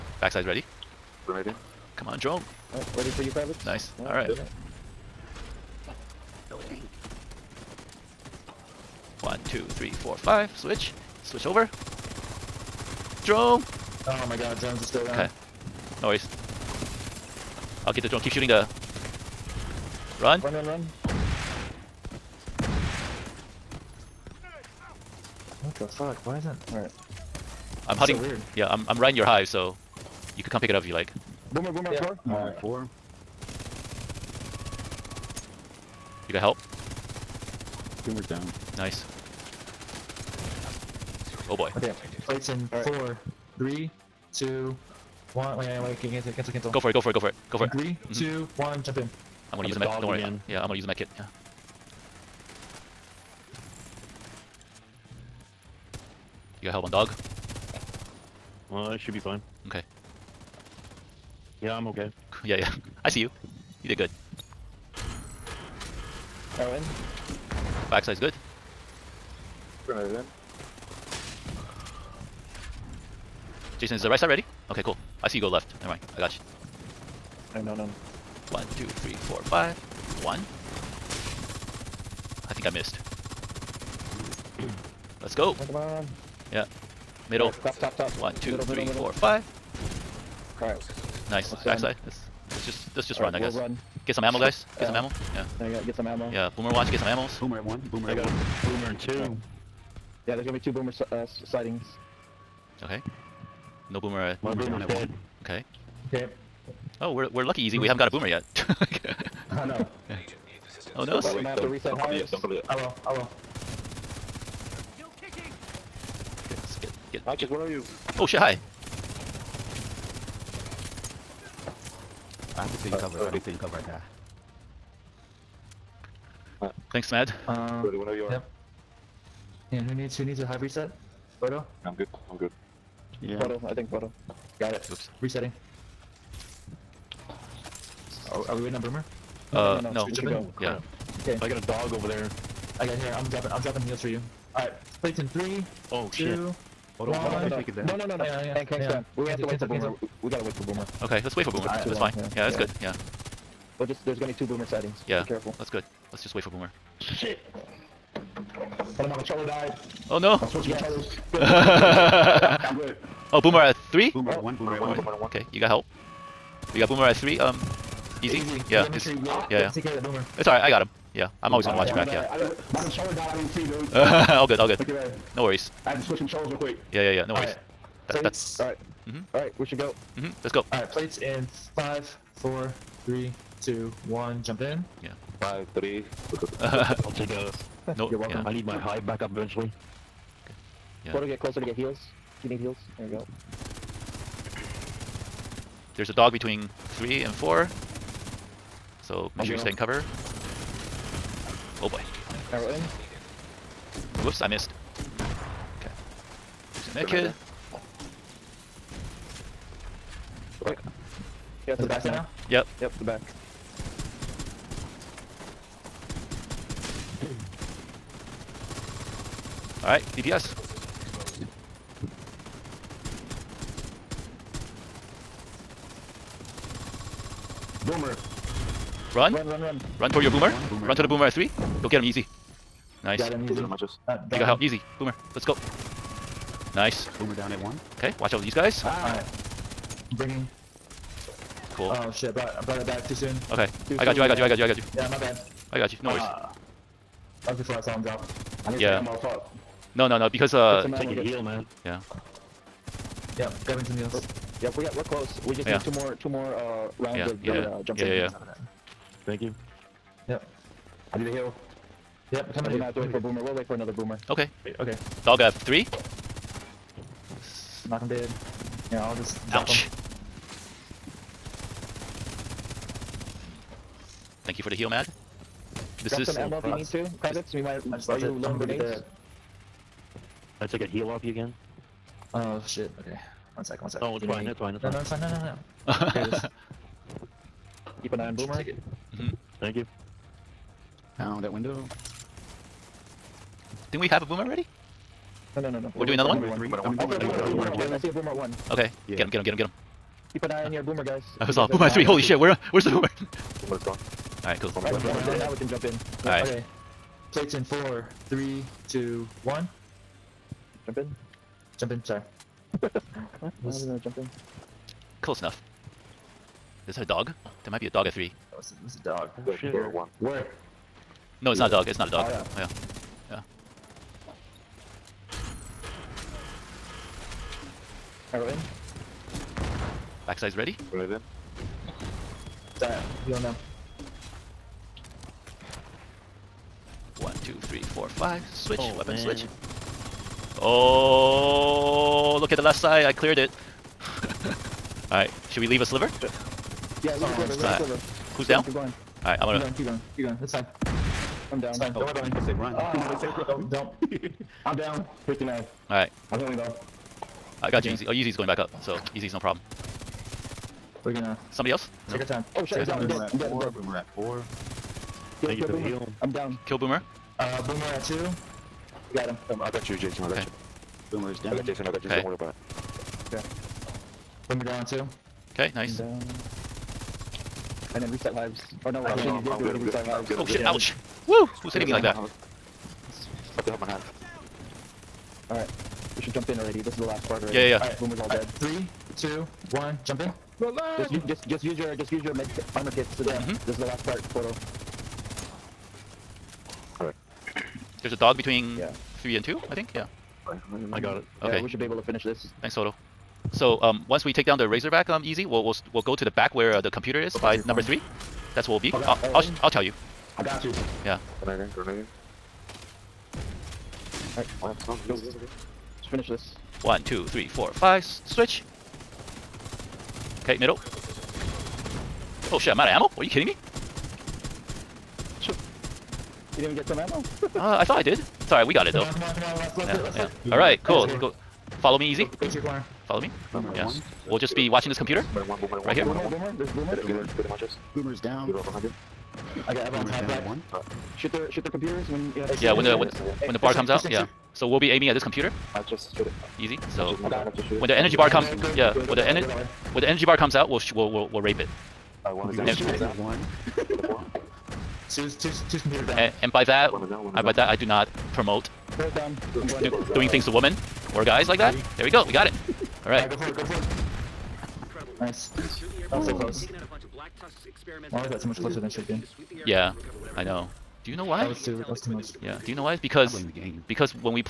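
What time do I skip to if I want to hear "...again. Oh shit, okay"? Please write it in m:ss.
4:41.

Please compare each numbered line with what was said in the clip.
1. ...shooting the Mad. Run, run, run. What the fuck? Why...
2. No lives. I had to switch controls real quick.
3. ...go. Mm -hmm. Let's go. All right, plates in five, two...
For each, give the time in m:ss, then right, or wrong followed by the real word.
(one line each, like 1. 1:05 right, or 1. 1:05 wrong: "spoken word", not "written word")
1. 0:18 wrong: "Run", not "Mad"
2. 2:55 wrong: "worries", not "lives"
3. 2:59 wrong: "four", not "two".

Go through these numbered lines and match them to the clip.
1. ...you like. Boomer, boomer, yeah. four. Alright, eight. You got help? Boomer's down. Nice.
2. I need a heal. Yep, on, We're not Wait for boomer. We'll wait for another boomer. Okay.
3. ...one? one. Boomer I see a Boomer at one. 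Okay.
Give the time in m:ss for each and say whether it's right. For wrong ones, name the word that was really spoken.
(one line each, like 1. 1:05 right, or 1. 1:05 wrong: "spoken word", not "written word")
1. 0:30 wrong: "four", not "eight"
2. 4:21 right
3. 4:56 right.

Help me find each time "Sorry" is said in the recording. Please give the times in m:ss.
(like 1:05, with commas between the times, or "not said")
5:12, 7:08.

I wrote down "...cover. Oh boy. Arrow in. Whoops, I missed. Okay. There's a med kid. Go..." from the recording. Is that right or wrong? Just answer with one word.
right.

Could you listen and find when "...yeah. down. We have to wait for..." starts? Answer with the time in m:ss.
2:28.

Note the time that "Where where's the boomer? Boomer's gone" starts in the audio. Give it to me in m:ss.
5:02.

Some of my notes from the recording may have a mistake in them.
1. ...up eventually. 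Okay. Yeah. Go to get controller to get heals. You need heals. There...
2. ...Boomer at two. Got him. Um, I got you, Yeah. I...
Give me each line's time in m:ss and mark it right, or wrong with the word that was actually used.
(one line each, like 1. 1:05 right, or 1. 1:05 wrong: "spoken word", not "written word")
1. 3:09 wrong: "closer", not "controller"
2. 6:07 wrong: "Jason", not "Yeah".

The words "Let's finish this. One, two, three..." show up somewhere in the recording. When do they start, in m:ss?
6:55.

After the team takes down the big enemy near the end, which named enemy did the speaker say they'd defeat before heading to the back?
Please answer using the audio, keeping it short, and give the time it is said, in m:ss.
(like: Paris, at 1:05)
Razorback, at 6:44.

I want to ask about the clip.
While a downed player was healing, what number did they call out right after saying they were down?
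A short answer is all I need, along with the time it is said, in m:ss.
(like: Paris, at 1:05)
59, at 5:55.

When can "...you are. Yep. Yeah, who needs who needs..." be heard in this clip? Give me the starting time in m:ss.
2:08.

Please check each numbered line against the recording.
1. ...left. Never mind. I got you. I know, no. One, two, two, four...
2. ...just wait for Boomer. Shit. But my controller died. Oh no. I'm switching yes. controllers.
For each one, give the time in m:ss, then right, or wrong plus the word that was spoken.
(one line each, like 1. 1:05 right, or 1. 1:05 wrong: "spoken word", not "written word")
1. 1:15 wrong: "three", not "two"
2. 2:36 right.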